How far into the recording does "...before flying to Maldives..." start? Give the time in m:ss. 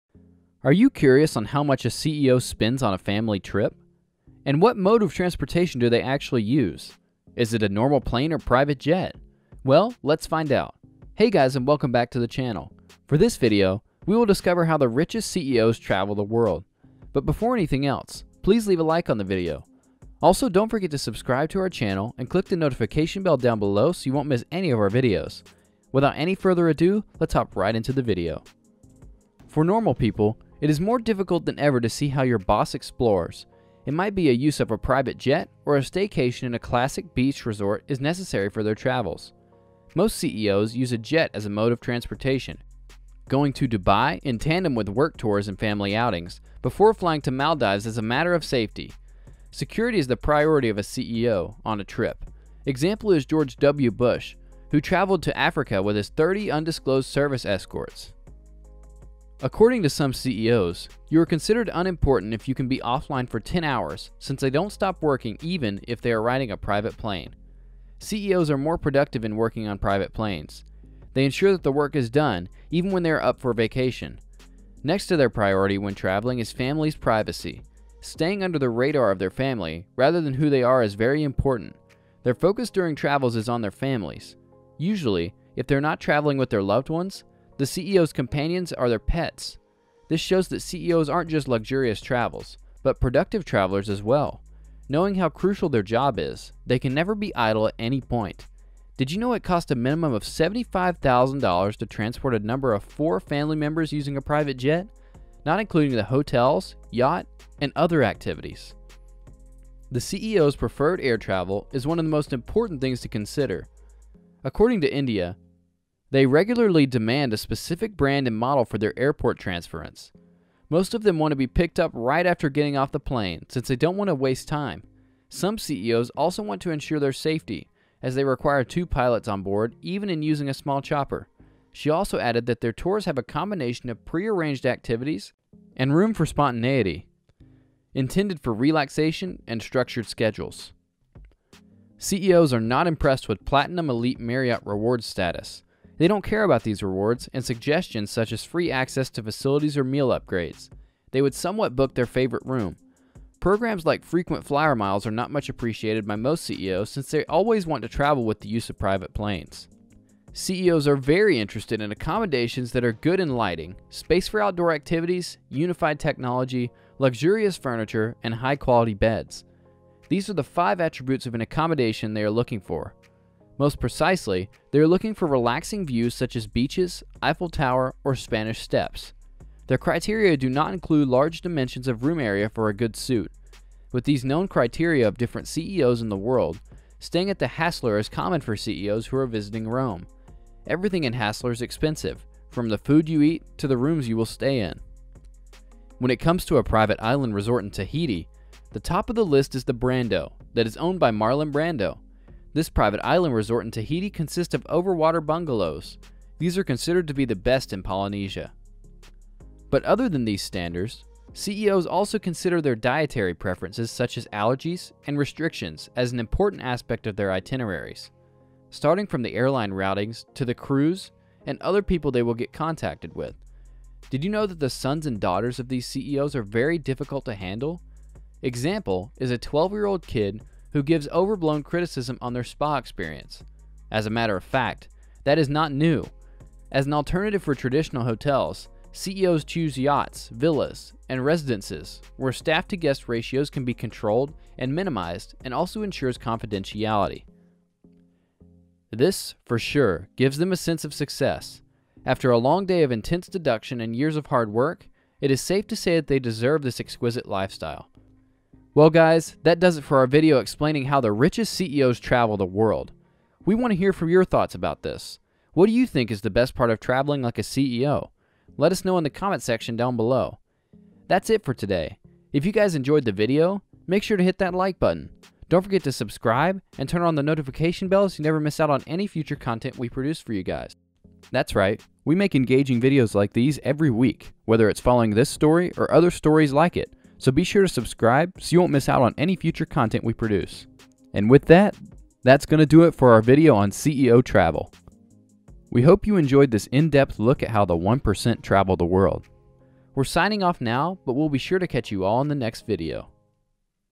0:46.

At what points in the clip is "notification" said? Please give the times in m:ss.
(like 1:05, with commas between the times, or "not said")
0:22, 4:37.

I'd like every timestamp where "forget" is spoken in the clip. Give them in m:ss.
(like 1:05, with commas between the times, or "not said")
0:20, 4:35.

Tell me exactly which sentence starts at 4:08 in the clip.
This, for sure, gives them a sense of success.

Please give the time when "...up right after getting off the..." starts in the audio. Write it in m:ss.
2:01.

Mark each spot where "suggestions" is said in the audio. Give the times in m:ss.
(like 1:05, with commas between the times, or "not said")
2:27.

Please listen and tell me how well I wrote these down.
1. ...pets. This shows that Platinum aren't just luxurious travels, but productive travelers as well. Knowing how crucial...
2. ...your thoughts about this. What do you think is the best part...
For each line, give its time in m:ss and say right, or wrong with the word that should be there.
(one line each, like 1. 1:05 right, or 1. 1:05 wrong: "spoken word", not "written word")
1. 1:28 wrong: "CEOs", not "Platinum"
2. 4:24 right.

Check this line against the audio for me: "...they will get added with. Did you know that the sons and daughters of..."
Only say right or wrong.
wrong.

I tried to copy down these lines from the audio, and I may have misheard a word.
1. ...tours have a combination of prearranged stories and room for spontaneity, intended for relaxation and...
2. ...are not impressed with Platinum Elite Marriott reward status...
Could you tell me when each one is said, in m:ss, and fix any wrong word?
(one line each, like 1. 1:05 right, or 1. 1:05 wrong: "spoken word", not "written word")
1. 2:12 wrong: "activities", not "stories"
2. 2:22 right.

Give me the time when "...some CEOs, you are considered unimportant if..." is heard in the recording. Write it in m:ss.
0:59.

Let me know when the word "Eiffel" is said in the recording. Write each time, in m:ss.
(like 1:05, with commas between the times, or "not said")
2:57.